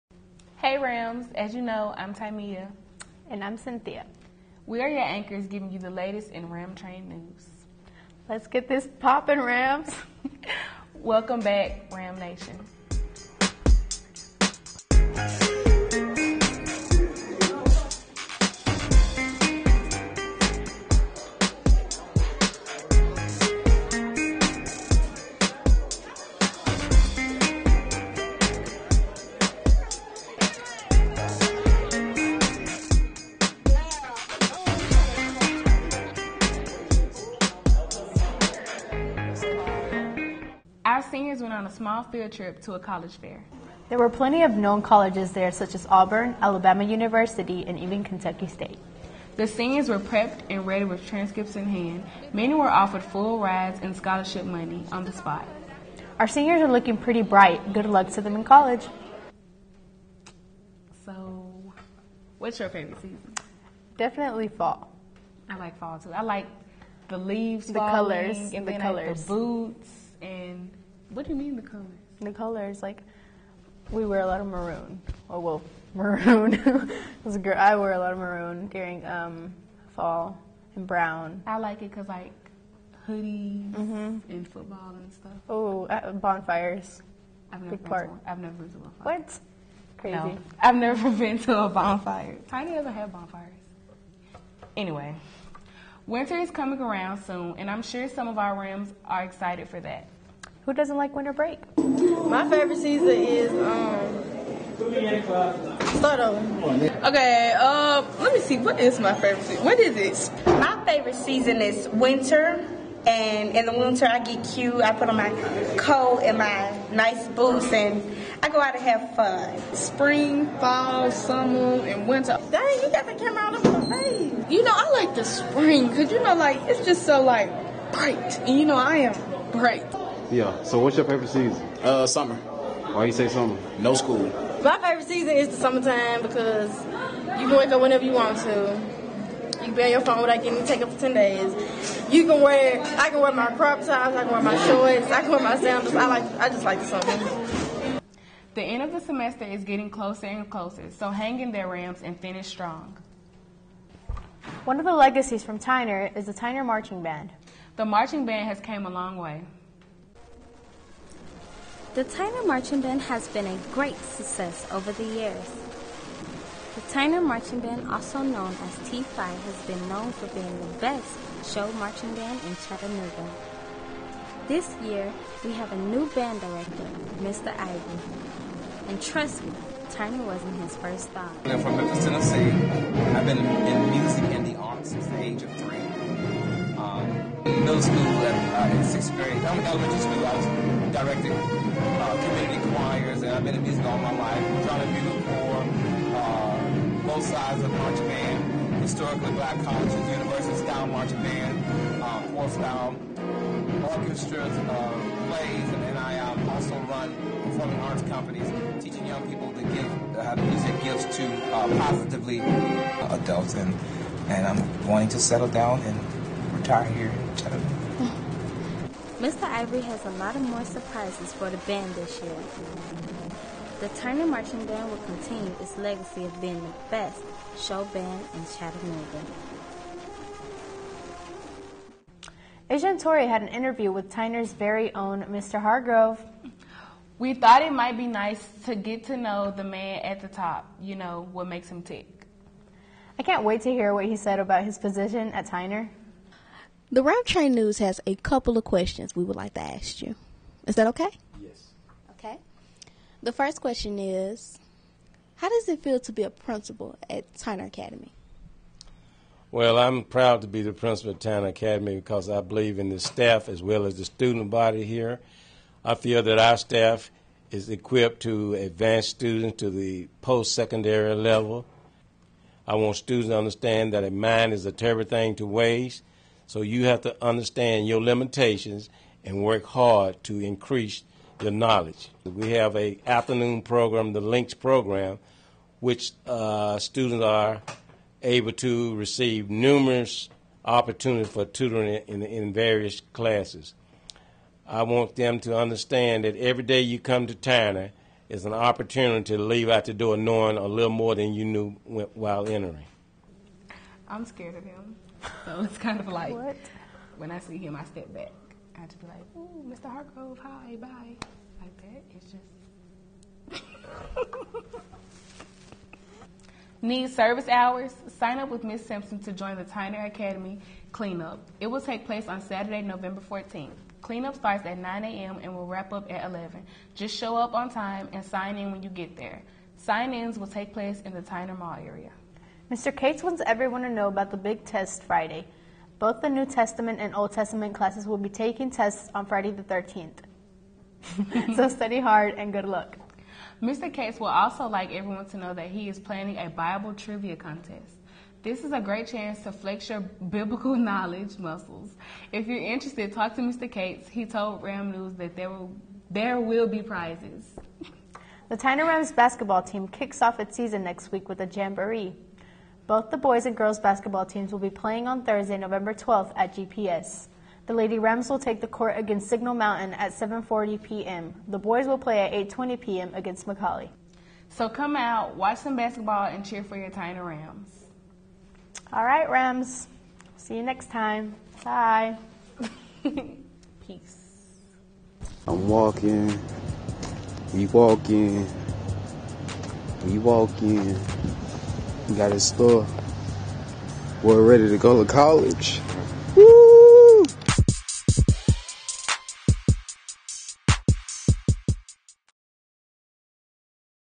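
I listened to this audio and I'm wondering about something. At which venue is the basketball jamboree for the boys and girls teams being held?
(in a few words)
GPS.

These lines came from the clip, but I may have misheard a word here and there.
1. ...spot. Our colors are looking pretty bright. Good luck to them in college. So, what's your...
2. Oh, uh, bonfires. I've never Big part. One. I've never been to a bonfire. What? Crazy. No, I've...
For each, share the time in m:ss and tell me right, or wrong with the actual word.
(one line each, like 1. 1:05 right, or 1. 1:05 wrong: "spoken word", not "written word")
1. 0:55 wrong: "seniors", not "colors"
2. 1:25 right.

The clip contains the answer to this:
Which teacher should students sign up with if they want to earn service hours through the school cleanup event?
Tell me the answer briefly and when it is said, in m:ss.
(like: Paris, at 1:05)
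Miss Simpson, at 5:18.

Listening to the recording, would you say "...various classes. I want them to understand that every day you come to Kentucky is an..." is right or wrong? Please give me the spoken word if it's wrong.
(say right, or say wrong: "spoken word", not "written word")
wrong: "Tyner", not "Kentucky".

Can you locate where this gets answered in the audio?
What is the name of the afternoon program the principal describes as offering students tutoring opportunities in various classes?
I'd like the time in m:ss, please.
4:44.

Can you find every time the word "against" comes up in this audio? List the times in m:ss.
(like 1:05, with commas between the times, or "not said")
6:08, 6:13.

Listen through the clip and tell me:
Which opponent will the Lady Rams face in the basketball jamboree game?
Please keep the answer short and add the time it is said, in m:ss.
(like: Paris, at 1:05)
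Signal Mountain, at 6:09.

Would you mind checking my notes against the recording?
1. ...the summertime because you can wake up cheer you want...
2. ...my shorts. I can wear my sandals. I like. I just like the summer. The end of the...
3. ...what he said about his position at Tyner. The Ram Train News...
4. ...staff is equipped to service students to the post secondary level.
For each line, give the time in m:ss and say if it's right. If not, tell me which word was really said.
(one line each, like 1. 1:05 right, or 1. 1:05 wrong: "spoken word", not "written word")
1. 2:15 wrong: "whenever", not "cheer"
2. 2:24 right
3. 4:03 right
4. 4:26 wrong: "advance", not "service".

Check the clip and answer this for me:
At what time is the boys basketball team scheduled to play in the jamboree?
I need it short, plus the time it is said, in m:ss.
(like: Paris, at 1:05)
8:20 p.m., at 6:12.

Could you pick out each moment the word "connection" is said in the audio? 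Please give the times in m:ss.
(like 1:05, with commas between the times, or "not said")
not said.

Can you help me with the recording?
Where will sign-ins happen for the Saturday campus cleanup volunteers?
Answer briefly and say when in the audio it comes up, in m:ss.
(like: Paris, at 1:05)
Tyner Mall area, at 5:31.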